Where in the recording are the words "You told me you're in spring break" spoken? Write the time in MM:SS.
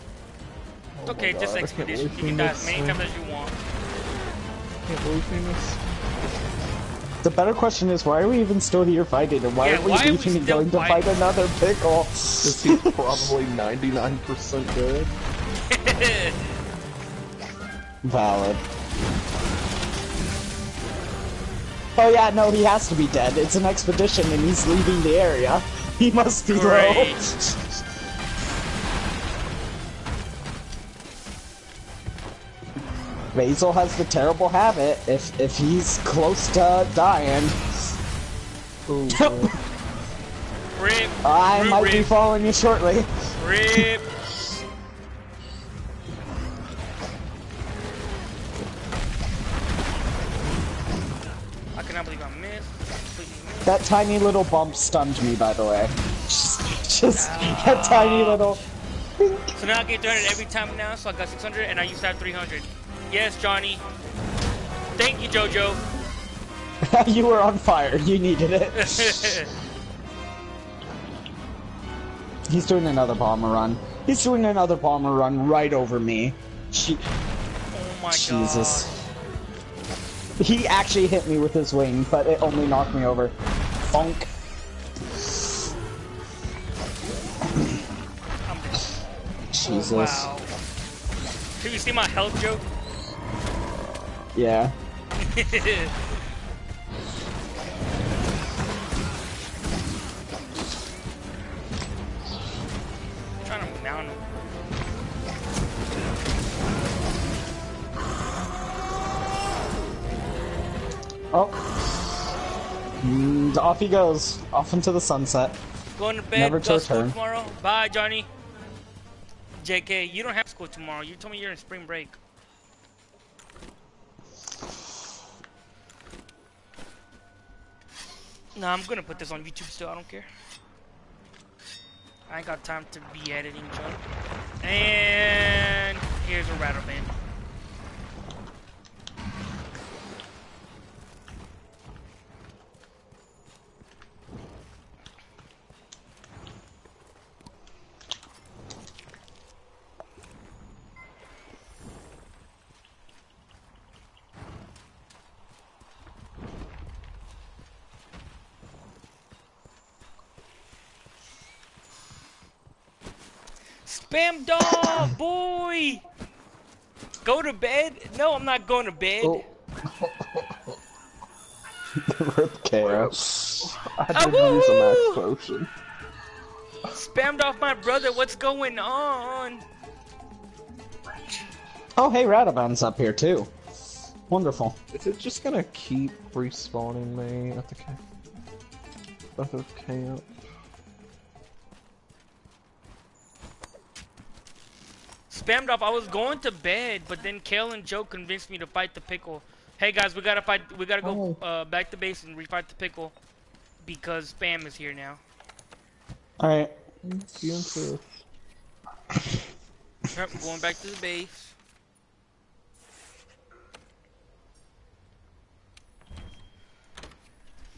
02:01.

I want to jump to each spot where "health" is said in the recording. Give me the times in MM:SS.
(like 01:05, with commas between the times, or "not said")
01:32.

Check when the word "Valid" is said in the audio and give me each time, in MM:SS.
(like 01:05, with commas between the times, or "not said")
00:18.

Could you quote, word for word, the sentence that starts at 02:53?
I didn't ah, use a max potion.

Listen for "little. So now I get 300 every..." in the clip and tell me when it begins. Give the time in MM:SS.
00:58.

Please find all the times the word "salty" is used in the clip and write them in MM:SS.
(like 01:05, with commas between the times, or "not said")
not said.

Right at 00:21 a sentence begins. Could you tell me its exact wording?
Oh yeah, no, he has to be dead.